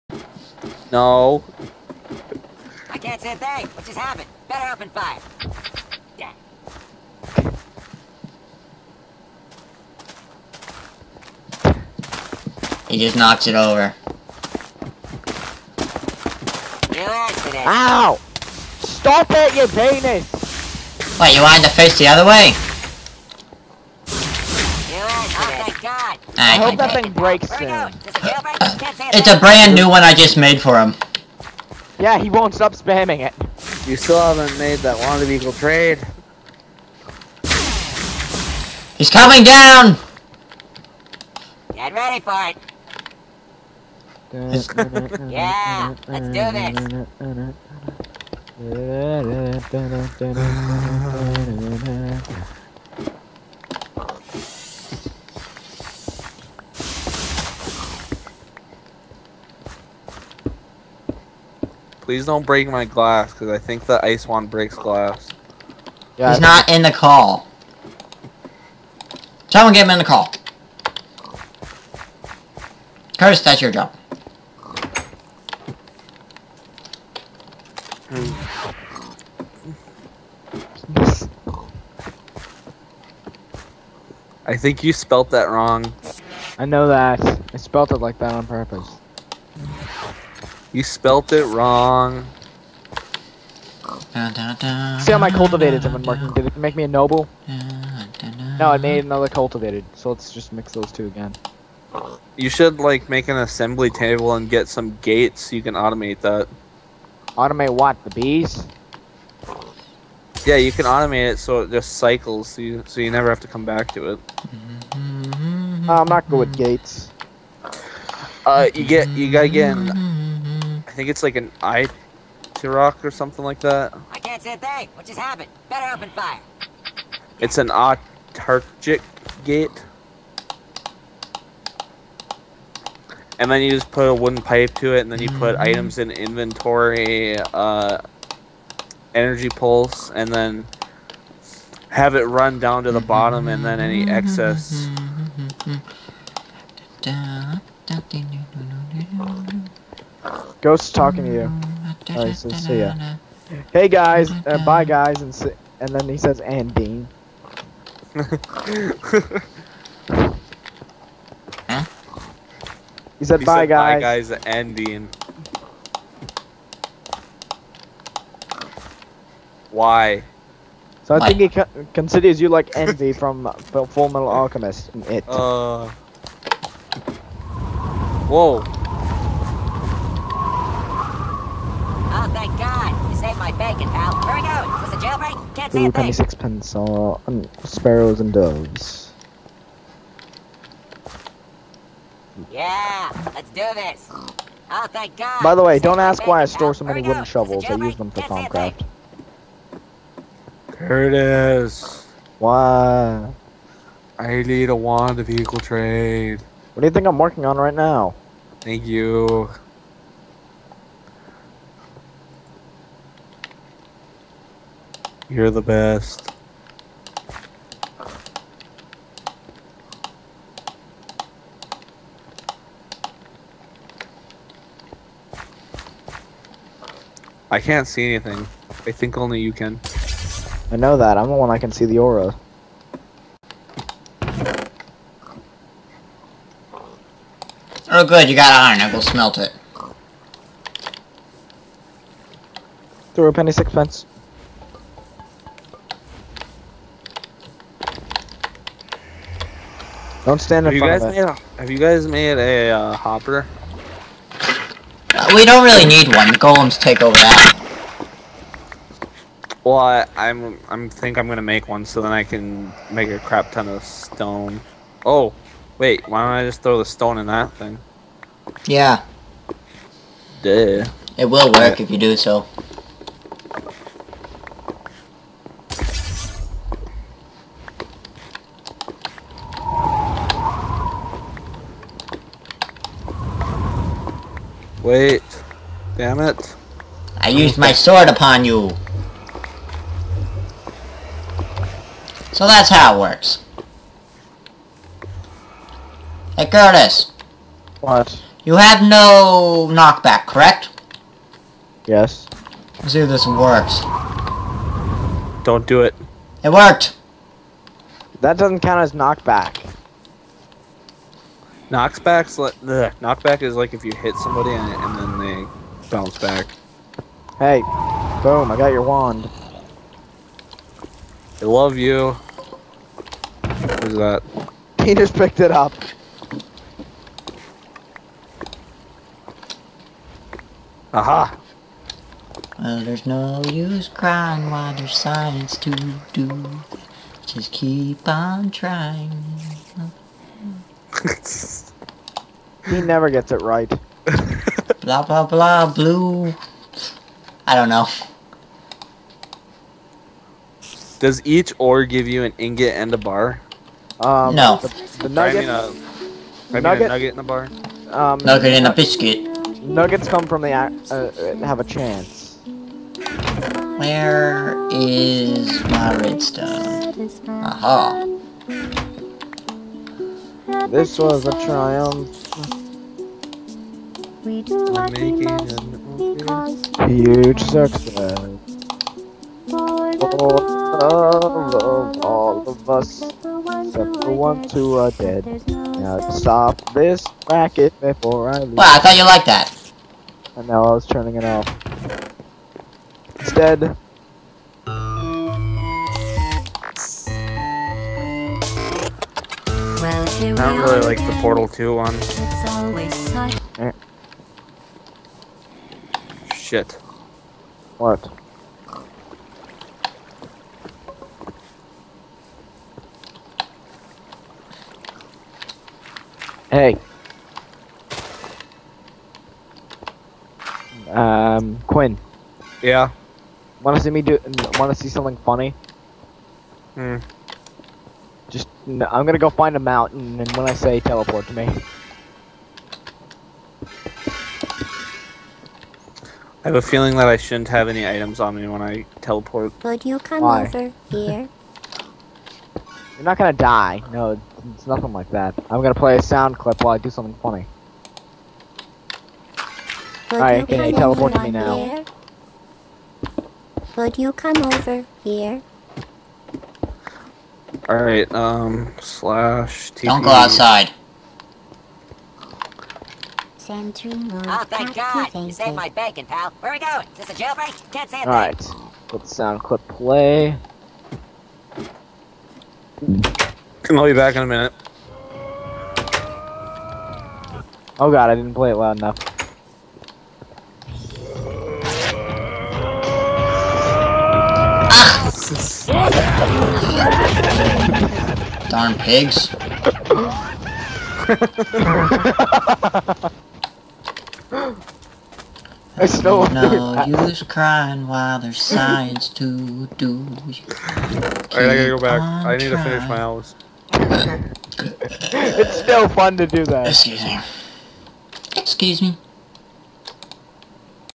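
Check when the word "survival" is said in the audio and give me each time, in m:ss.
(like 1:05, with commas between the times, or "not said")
not said.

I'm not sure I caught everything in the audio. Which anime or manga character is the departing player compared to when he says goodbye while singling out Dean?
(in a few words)
Envy.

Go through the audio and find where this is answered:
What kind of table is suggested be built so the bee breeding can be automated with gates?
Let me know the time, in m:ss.
1:43.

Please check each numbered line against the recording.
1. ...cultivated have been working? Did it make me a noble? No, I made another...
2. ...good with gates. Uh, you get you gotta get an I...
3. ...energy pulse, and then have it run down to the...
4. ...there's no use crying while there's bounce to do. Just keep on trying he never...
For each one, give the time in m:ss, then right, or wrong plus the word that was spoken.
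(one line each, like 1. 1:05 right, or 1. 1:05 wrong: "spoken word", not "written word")
1. 1:35 right
2. 1:56 right
3. 2:19 right
4. 5:32 wrong: "science", not "bounce".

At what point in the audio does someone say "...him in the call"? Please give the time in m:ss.
1:09.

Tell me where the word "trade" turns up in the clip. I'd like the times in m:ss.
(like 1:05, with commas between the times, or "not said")
0:35, 3:25.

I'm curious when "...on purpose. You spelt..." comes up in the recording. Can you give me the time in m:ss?
1:28.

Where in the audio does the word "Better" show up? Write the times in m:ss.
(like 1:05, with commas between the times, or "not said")
0:04, 2:05.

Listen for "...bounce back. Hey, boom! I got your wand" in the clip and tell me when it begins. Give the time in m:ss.
5:15.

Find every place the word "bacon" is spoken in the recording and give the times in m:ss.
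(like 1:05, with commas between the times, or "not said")
3:03, 7:45.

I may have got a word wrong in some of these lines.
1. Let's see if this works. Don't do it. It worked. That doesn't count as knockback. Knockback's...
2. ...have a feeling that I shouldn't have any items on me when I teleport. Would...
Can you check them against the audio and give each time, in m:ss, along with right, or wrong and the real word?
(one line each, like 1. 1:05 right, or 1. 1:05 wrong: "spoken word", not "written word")
1. 5:02 right
2. 7:16 right.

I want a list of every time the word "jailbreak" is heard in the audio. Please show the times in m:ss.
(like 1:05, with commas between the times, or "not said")
3:05, 7:47.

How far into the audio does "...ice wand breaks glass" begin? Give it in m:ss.
1:04.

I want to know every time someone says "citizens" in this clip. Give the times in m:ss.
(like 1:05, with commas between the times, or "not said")
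not said.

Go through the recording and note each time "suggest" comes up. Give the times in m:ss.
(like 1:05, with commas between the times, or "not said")
not said.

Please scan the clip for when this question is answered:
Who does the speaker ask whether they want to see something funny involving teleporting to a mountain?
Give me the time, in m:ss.
7:01.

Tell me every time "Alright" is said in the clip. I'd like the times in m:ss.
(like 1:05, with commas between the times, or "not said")
7:30, 7:37, 7:48, 8:20.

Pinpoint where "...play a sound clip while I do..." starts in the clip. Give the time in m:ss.
7:25.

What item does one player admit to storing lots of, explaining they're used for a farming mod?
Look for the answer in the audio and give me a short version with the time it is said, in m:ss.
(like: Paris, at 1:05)
wooden shovels, at 3:17.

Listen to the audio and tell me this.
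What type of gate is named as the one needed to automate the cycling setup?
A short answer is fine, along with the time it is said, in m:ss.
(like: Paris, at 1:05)
autarchic gate, at 2:07.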